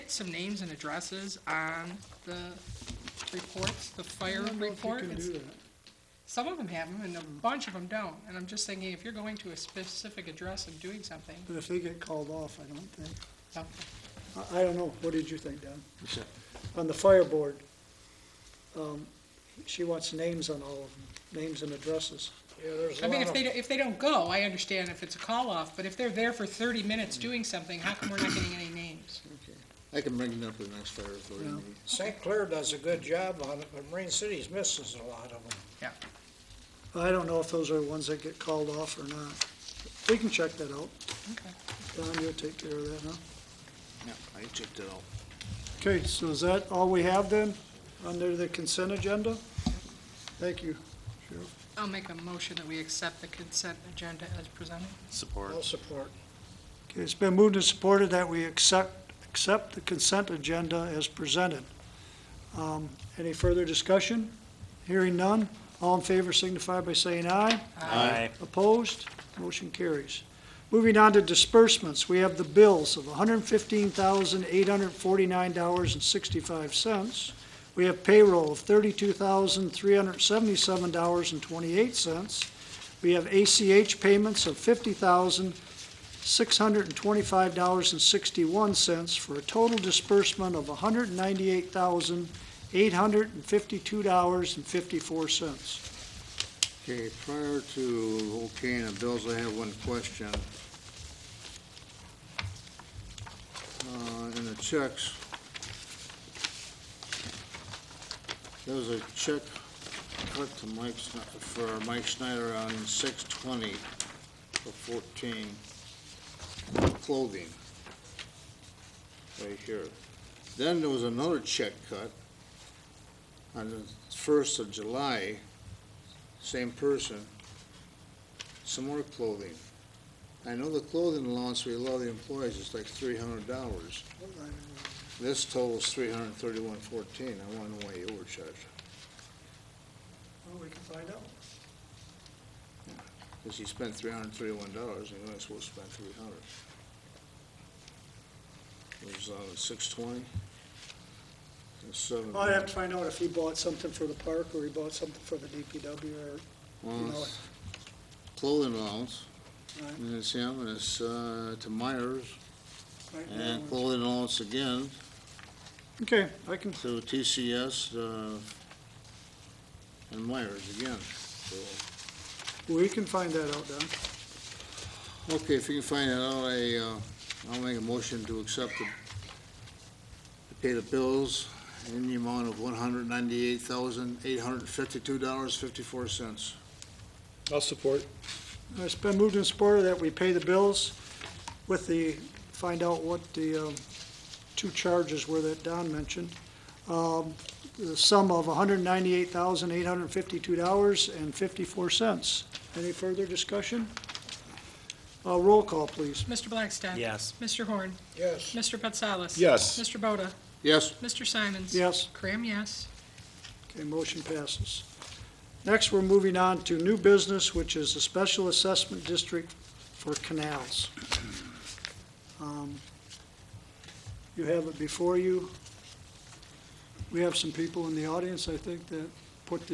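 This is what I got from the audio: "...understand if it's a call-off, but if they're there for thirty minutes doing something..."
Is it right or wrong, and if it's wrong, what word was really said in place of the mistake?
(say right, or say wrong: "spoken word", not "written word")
right.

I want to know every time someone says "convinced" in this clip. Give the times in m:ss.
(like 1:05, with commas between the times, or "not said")
not said.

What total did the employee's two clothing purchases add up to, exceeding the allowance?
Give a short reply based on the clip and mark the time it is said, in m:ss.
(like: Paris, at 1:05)
$331.14, at 2:15.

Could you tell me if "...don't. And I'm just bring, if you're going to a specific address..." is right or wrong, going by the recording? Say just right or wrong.
wrong.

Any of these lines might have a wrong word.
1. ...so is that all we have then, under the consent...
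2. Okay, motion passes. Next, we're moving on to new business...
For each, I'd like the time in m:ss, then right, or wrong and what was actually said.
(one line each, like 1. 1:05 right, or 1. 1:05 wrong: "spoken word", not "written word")
1. 0:46 right
2. 3:33 right.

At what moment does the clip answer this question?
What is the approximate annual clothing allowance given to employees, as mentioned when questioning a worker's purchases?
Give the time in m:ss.
2:12.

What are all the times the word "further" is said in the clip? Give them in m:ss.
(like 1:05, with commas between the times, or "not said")
1:03, 3:22.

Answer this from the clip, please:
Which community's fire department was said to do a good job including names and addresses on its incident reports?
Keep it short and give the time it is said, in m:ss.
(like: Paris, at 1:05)
St. Clair, at 0:31.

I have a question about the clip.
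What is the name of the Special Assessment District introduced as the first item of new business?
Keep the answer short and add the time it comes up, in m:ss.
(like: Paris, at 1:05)
Canals, at 3:40.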